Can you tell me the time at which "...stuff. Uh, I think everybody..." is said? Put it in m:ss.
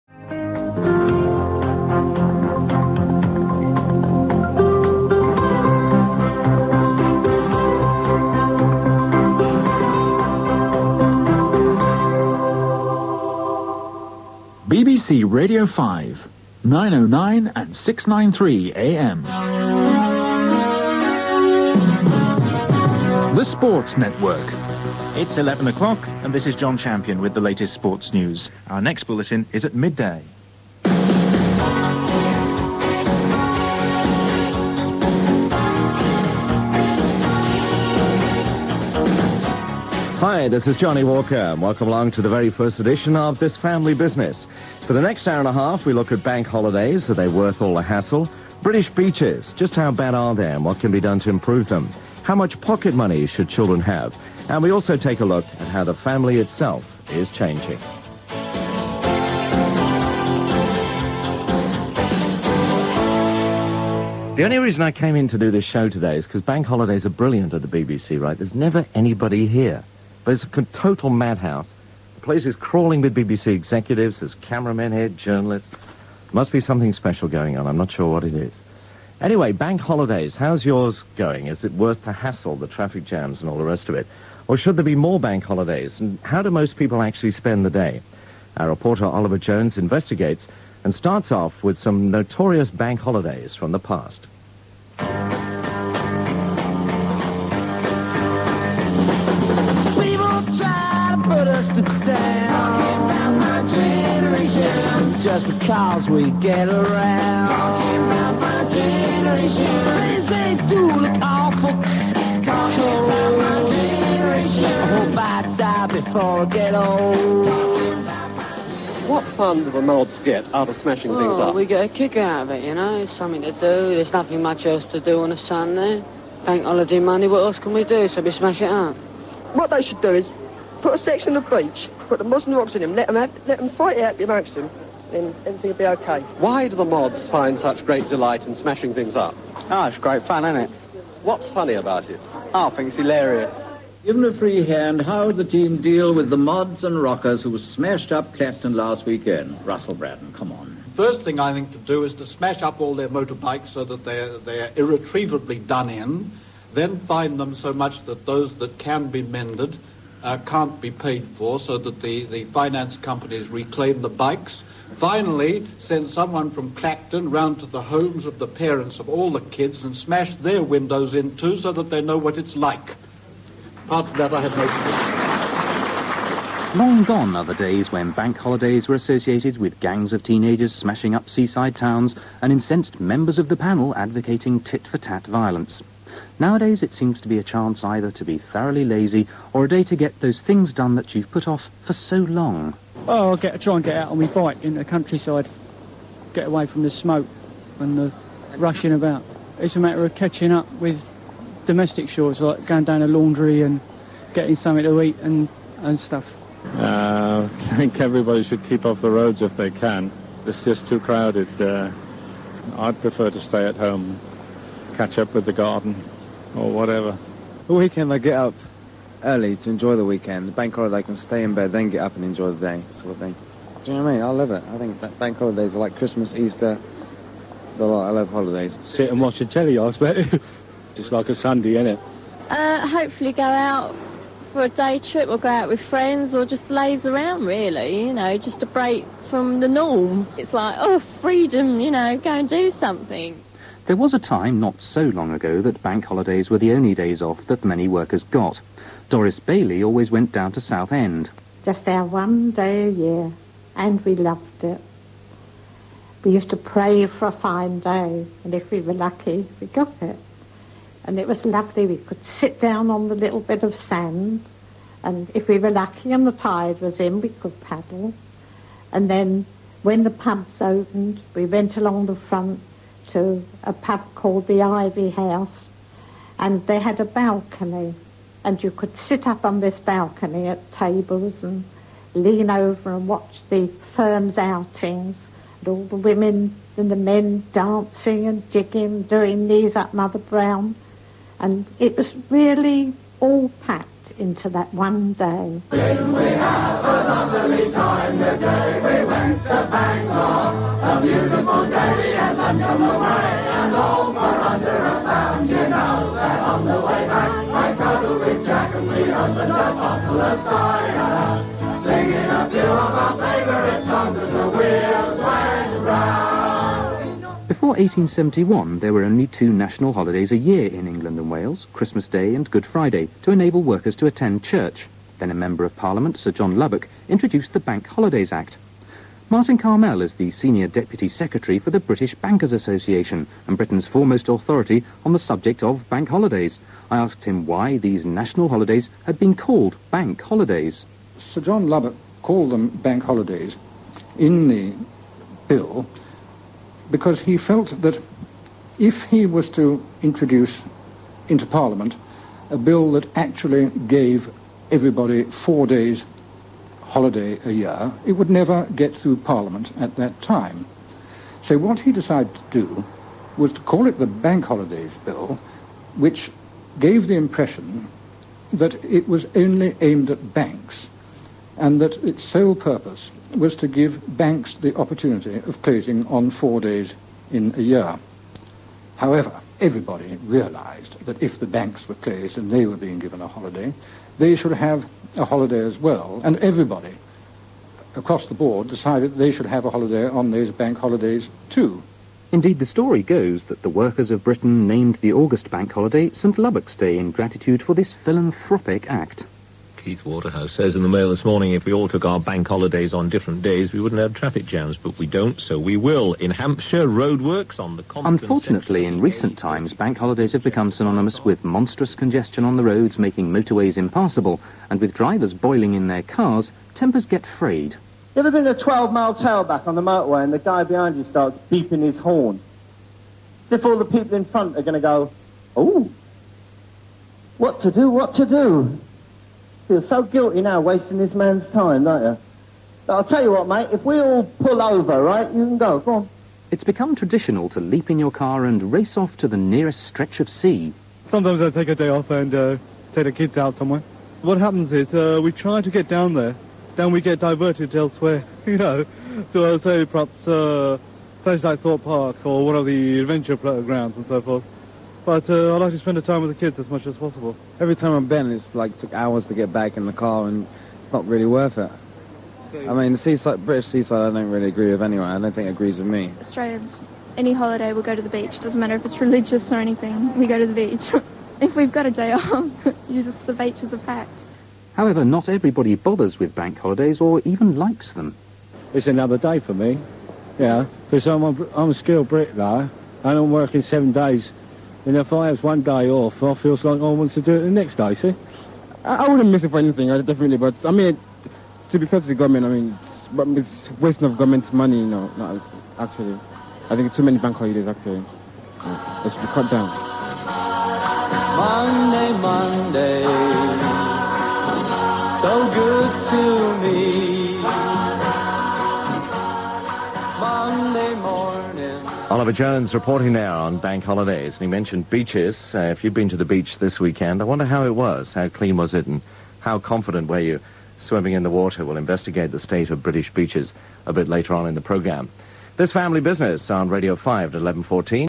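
3:25.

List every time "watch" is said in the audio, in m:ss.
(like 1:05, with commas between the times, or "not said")
3:49, 4:43.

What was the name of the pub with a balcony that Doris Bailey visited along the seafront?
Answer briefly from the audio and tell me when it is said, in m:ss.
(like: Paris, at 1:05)
The Ivy House, at 4:34.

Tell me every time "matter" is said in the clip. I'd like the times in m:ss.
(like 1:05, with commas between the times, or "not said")
3:19, 7:48.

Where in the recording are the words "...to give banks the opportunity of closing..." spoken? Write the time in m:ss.
6:13.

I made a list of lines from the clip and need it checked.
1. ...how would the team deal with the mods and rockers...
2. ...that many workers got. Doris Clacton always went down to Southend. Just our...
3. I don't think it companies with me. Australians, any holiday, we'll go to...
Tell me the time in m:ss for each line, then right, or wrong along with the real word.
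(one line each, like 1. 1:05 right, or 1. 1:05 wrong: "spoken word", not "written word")
1. 2:25 right
2. 4:07 wrong: "Bailey", not "Clacton"
3. 7:45 wrong: "agrees", not "companies".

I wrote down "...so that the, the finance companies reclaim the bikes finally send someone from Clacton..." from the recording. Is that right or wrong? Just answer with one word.
right.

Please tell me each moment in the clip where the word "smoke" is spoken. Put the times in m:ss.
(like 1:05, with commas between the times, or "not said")
3:16.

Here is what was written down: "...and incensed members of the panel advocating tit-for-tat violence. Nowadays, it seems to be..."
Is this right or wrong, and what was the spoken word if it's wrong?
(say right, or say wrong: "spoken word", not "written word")
right.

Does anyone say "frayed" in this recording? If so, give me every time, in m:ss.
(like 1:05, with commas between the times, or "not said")
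6:57.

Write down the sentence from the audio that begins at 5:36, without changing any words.
I asked him why these national holidays had been called bank holidays.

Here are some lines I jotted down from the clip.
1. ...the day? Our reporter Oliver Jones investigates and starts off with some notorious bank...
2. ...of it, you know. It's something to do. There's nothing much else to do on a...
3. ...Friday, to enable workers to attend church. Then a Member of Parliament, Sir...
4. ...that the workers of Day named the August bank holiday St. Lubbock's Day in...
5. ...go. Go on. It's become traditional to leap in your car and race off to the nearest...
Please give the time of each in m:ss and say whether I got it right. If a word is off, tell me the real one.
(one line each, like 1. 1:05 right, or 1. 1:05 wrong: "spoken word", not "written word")
1. 1:27 right
2. 2:02 right
3. 5:22 right
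4. 6:33 wrong: "Britain", not "Day"
5. 7:15 right.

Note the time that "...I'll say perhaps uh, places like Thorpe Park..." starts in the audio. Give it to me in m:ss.
7:29.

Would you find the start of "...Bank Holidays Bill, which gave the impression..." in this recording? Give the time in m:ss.
6:04.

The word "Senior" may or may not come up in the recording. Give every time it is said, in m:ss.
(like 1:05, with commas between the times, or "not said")
5:30.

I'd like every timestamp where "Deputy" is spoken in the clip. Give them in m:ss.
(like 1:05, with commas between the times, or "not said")
5:30.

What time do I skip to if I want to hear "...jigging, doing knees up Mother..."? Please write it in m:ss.
4:48.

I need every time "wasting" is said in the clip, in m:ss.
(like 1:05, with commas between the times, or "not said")
7:10, 8:13.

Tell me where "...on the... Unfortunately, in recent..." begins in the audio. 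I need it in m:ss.
6:47.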